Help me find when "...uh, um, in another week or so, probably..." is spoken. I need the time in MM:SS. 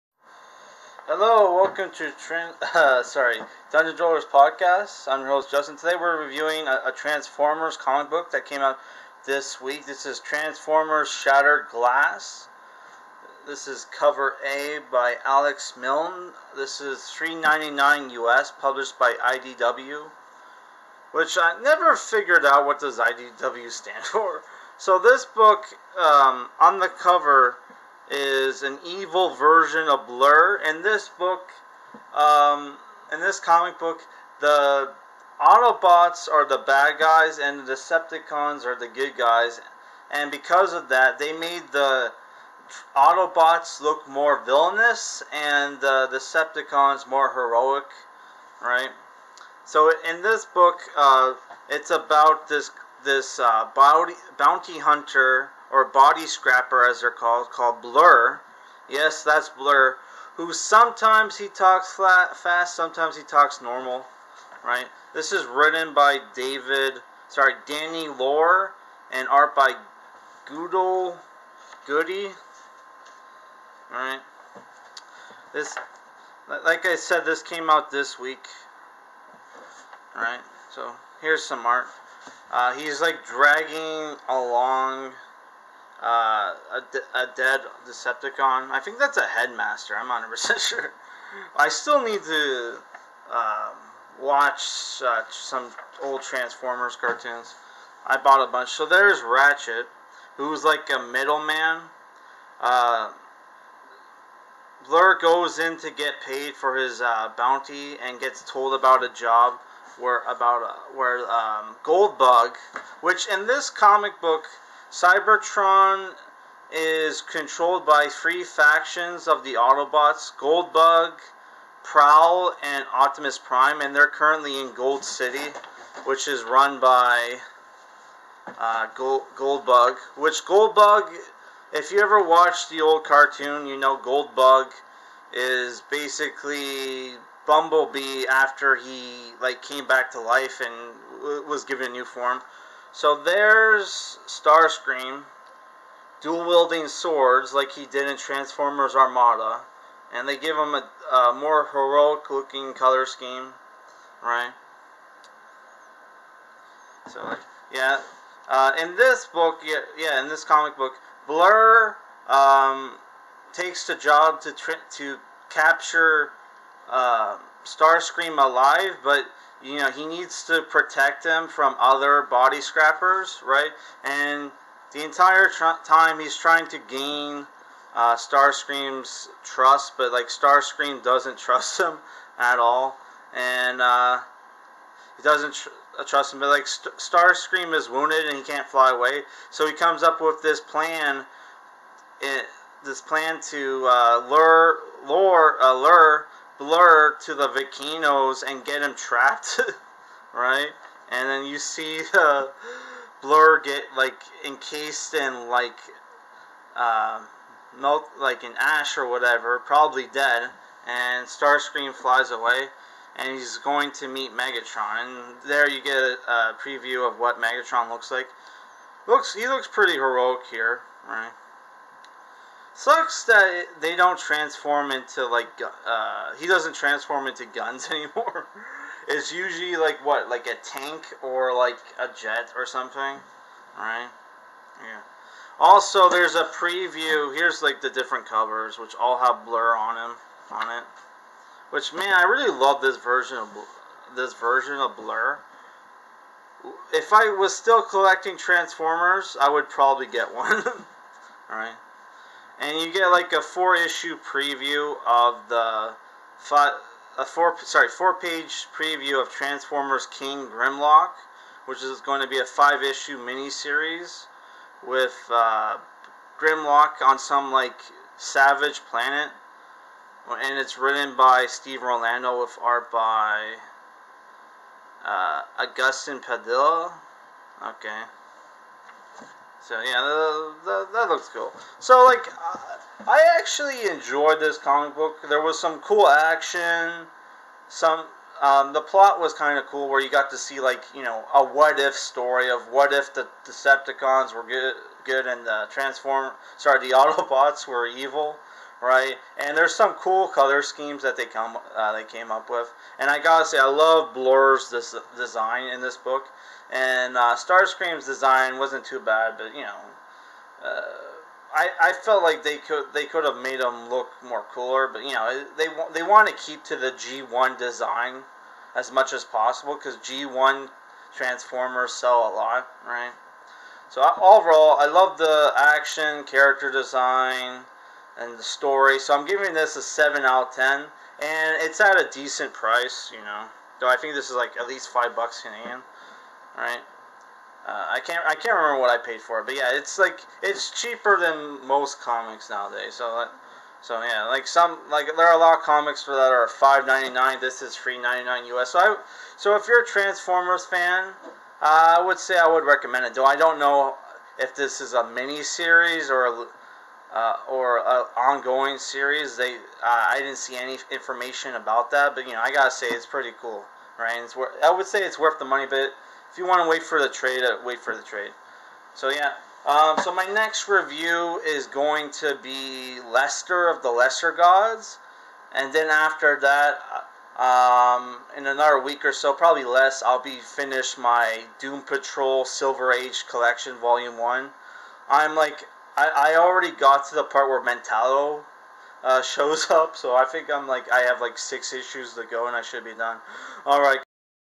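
06:17.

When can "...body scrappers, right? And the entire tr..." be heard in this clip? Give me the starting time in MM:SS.
02:52.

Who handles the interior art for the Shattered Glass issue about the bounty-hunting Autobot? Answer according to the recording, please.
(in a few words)
Guido Guidi.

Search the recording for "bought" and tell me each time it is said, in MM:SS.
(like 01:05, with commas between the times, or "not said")
01:38.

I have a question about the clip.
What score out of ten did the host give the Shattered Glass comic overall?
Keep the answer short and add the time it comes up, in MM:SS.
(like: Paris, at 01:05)
7, at 05:29.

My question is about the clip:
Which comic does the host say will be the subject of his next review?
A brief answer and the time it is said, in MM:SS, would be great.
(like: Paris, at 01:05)
Lester of the Lesser Gods, at 06:13.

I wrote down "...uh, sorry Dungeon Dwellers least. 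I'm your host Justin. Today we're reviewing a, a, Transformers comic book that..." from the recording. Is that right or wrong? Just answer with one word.
wrong.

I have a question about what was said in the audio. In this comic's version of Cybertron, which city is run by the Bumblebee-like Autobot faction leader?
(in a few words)
Gold City.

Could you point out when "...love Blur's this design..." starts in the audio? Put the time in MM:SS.
05:03.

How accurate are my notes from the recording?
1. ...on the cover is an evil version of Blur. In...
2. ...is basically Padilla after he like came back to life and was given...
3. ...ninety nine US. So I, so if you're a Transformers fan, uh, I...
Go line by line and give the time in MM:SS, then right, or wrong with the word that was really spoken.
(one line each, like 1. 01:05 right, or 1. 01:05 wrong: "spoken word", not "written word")
1. 00:26 right
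2. 02:15 wrong: "Bumblebee", not "Padilla"
3. 05:48 right.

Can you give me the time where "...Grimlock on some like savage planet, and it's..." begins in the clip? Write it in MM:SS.
04:26.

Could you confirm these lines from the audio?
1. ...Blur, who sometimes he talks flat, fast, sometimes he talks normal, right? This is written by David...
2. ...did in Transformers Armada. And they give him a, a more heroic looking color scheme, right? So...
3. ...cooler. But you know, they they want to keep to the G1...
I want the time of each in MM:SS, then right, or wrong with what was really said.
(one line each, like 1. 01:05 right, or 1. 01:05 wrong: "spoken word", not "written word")
1. 00:59 right
2. 02:27 right
3. 05:14 right.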